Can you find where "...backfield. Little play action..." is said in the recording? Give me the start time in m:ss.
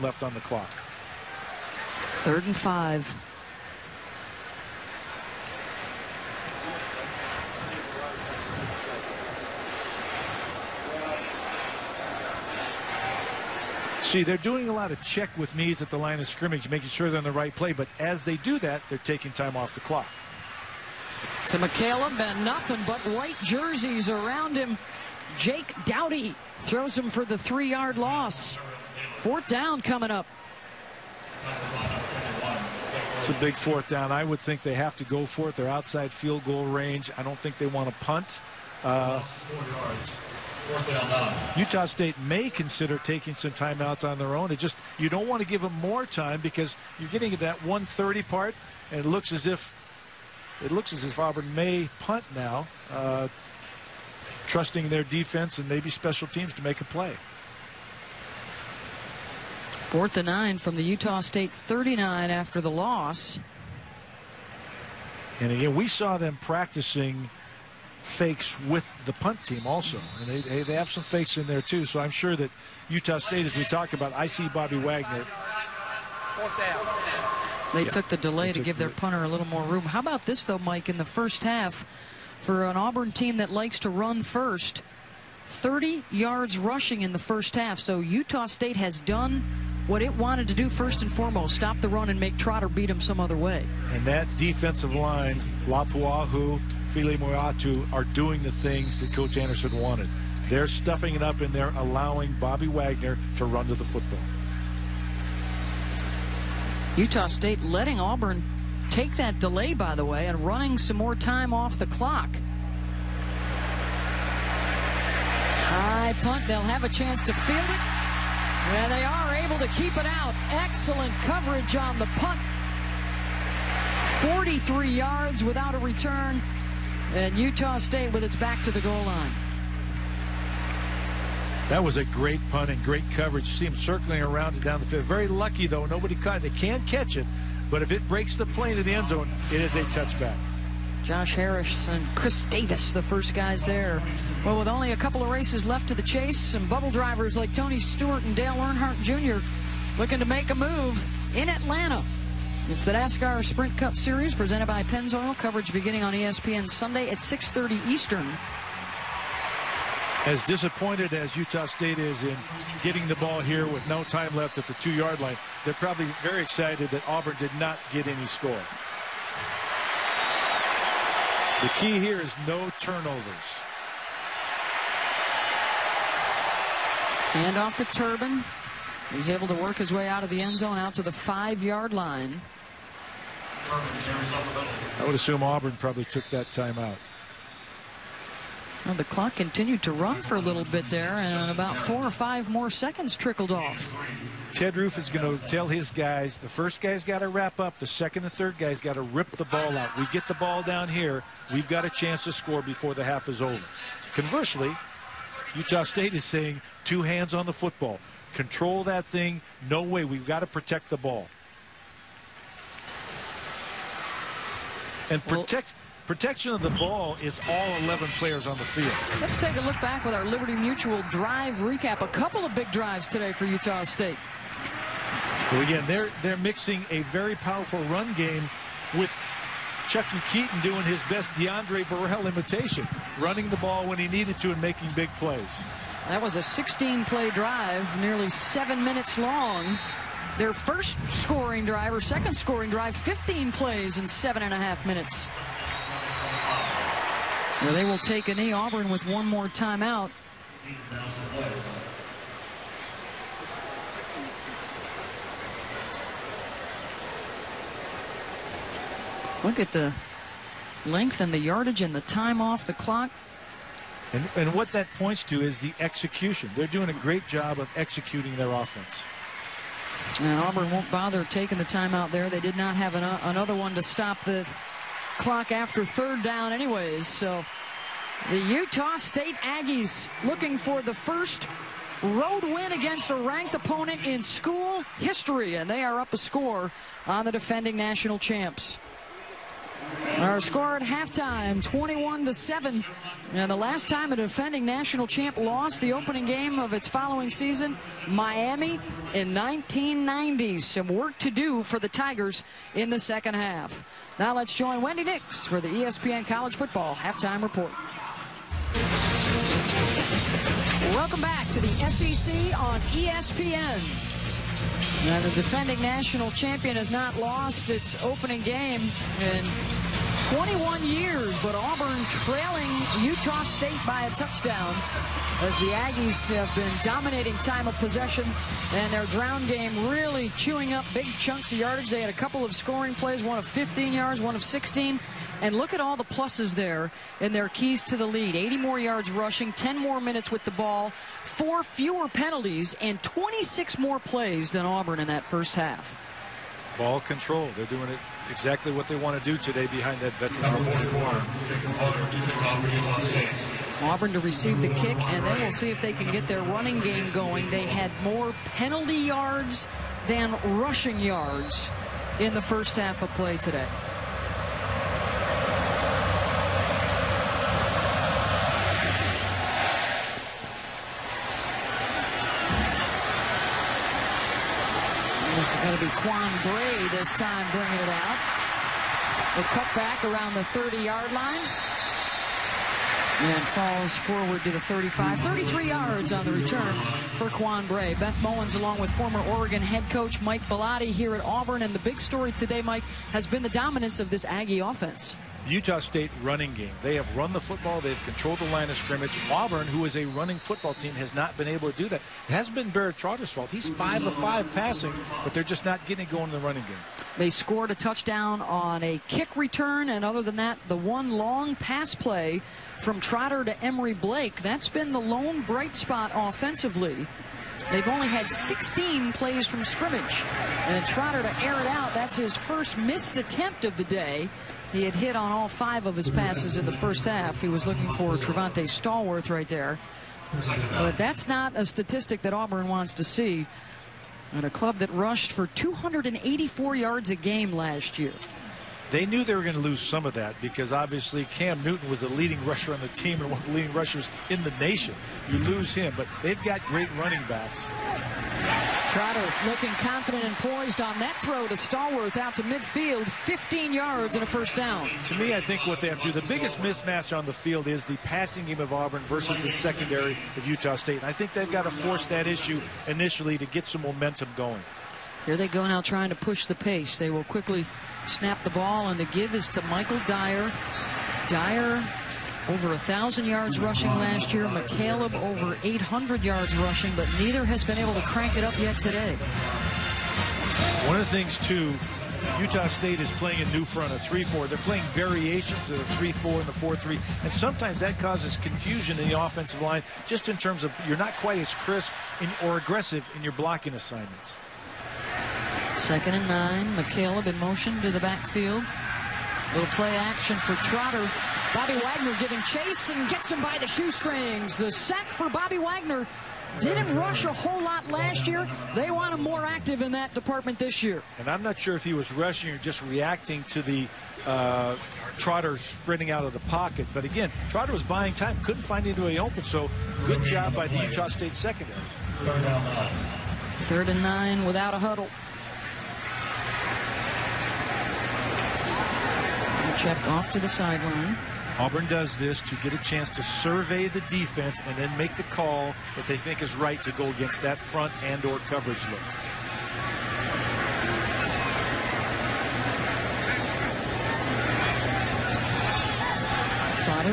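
8:18.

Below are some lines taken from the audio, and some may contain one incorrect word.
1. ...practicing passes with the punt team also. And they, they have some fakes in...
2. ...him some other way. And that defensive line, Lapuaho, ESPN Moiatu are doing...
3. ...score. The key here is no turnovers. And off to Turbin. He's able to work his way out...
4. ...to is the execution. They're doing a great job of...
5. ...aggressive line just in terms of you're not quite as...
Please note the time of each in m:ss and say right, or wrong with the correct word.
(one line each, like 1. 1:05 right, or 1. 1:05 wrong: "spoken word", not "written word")
1. 1:06 wrong: "fakes", not "passes"
2. 1:32 wrong: "Fili", not "ESPN"
3. 2:48 right
4. 4:25 right
5. 8:09 wrong: "offensive", not "aggressive".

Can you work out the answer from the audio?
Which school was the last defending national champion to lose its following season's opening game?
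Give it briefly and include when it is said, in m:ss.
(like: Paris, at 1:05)
Miami, at 4:58.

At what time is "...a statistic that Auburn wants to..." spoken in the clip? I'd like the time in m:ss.
7:11.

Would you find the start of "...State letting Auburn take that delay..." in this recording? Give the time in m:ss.
1:47.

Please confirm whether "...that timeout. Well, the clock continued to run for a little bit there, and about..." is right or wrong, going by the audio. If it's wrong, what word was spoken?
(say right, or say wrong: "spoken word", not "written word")
right.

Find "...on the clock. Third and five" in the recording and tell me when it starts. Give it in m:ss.
0:00.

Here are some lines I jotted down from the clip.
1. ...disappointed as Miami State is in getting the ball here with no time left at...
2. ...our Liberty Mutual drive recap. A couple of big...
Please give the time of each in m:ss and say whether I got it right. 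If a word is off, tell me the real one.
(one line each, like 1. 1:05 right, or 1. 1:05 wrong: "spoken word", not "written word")
1. 2:40 wrong: "Utah", not "Miami"
2. 3:40 right.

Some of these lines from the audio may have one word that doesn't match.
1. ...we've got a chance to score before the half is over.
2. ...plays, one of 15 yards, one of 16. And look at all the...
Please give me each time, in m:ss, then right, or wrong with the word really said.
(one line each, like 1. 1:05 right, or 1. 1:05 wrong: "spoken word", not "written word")
1. 3:21 right
2. 5:32 right.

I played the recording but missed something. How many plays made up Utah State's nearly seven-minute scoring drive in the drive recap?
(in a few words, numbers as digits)
16.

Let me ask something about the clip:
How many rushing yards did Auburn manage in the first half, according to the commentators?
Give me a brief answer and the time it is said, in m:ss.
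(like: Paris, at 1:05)
30, at 1:25.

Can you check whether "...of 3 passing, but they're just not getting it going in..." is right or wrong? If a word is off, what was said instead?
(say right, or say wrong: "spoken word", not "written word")
wrong: "5", not "3".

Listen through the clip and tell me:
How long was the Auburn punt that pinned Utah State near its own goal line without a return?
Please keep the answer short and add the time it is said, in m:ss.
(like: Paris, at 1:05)
43 yards, at 2:04.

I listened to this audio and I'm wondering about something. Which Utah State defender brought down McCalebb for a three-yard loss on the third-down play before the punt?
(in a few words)
Jake Doughty.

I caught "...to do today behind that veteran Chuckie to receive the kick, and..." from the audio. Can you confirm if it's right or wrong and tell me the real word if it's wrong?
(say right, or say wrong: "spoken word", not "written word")
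wrong: "Auburn", not "Chuckie".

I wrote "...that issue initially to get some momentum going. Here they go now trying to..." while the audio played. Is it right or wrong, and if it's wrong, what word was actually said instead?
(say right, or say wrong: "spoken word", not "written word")
right.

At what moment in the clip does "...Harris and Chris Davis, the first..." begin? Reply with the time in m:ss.
2:21.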